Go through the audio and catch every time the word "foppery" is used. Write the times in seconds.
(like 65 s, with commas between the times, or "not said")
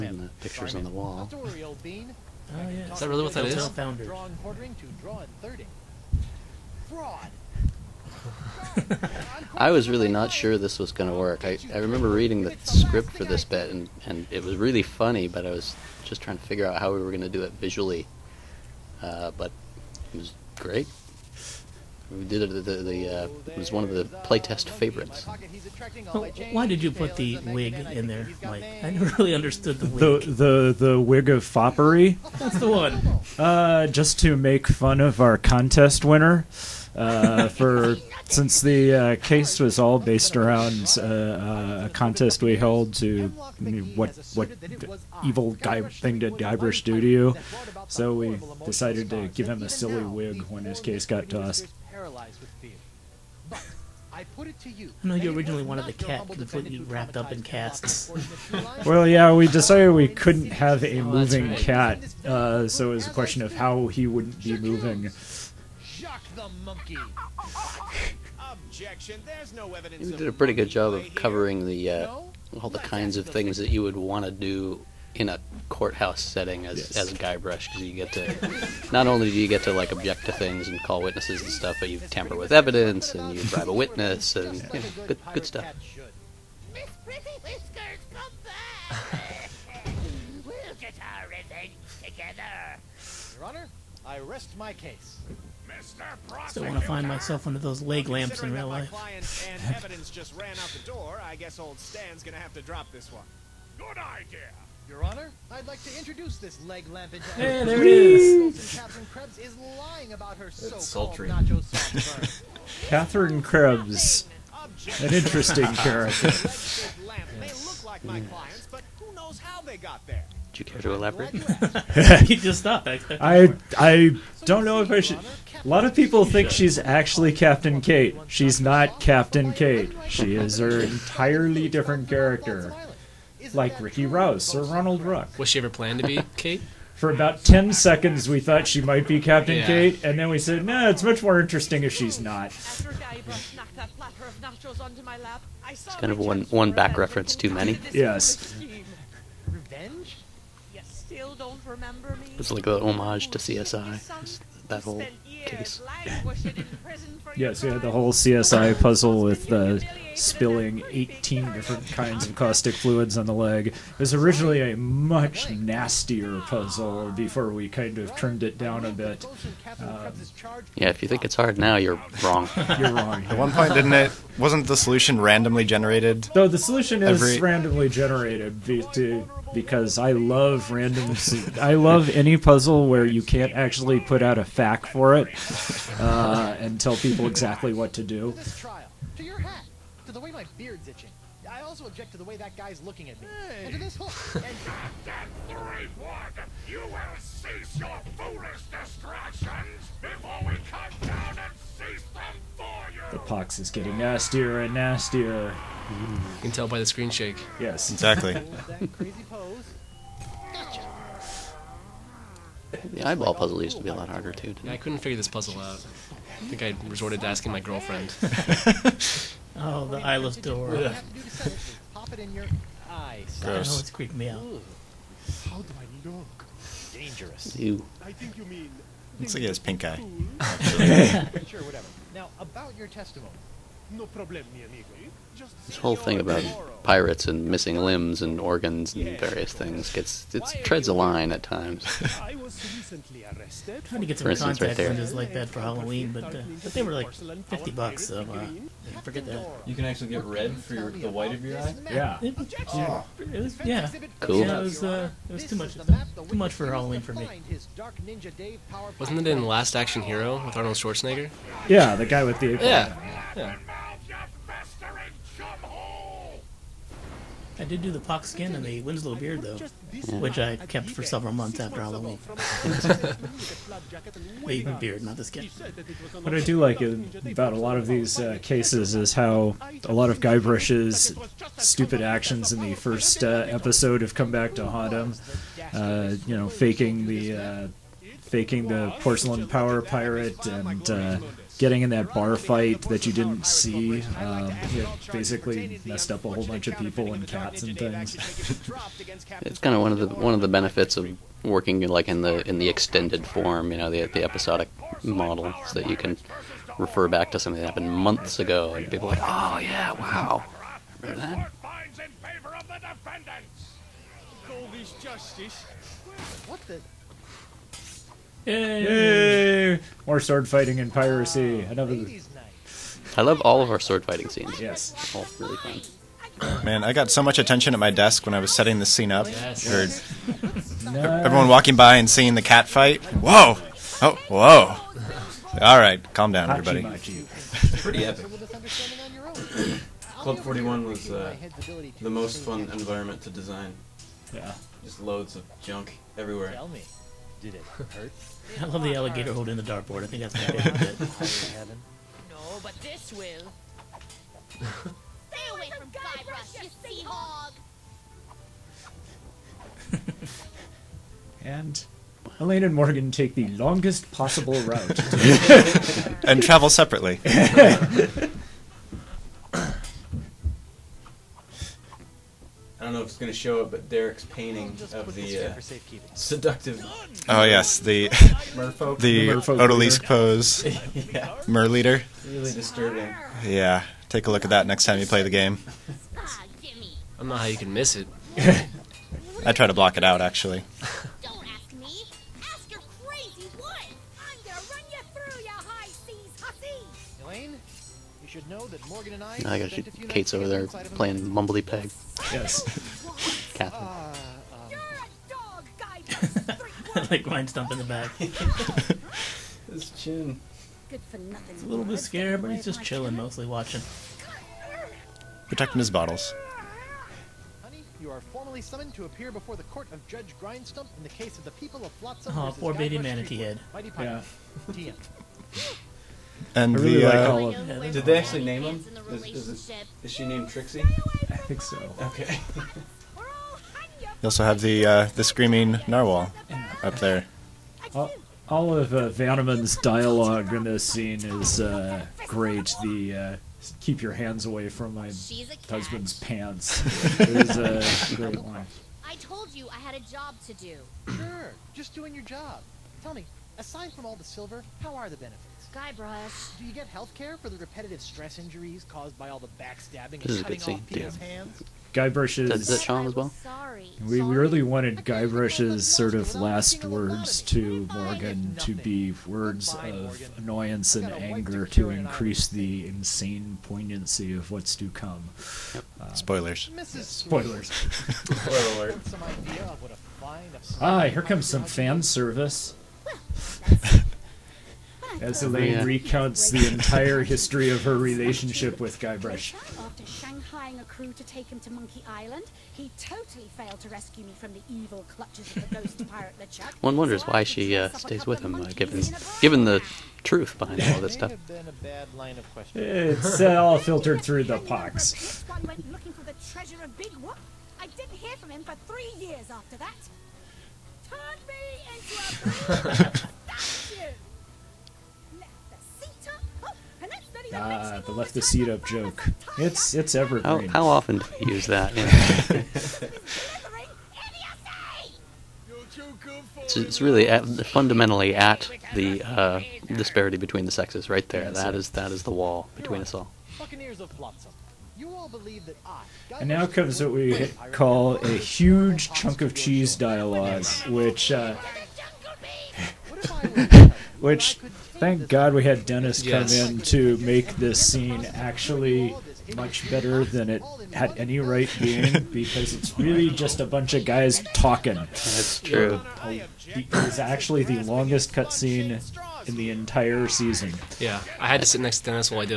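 31 s.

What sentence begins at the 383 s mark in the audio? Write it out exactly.
Yeah, take a look at that next time you play the game.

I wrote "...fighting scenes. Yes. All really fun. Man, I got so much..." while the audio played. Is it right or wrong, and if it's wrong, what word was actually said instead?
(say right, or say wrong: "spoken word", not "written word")
right.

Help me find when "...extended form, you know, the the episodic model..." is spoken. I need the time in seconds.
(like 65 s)
302 s.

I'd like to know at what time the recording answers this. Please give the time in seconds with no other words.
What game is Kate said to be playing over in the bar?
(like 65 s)
401 s.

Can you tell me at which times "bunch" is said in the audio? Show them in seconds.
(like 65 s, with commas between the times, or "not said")
296 s, 553 s.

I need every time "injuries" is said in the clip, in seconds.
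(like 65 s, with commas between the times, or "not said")
458 s.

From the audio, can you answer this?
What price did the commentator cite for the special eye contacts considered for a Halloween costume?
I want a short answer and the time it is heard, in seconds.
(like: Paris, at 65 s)
fifty bucks, at 247 s.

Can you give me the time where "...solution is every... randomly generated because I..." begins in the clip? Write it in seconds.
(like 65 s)
176 s.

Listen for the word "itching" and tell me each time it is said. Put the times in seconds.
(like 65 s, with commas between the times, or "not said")
190 s.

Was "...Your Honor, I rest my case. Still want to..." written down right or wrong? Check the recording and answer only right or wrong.
right.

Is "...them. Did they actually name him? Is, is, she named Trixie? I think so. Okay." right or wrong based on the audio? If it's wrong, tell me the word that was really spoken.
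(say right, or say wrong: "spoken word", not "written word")
right.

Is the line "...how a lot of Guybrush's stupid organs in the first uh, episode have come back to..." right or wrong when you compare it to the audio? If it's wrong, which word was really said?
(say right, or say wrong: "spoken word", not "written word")
wrong: "actions", not "organs".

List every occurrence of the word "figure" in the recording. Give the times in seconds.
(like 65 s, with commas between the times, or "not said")
16 s, 214 s.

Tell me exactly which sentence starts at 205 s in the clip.
You can tell by the screen shake.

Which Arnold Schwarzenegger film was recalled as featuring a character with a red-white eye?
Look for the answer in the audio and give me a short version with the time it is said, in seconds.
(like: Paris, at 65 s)
Last Action Hero, at 259 s.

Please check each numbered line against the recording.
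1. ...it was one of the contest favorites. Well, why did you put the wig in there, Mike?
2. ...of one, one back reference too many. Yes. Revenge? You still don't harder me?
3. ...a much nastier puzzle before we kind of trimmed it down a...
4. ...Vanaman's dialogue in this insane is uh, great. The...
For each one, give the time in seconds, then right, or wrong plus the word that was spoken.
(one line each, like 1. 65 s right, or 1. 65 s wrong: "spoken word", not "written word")
1. 23 s wrong: "playtest", not "contest"
2. 146 s wrong: "remember", not "harder"
3. 164 s right
4. 439 s wrong: "scene", not "insane".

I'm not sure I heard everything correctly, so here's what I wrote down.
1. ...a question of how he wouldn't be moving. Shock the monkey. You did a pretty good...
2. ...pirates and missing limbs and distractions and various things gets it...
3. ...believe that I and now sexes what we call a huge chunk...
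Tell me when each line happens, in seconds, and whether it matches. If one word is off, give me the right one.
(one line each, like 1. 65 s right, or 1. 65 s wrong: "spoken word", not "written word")
1. 63 s right
2. 236 s wrong: "organs", not "distractions"
3. 535 s wrong: "comes", not "sexes".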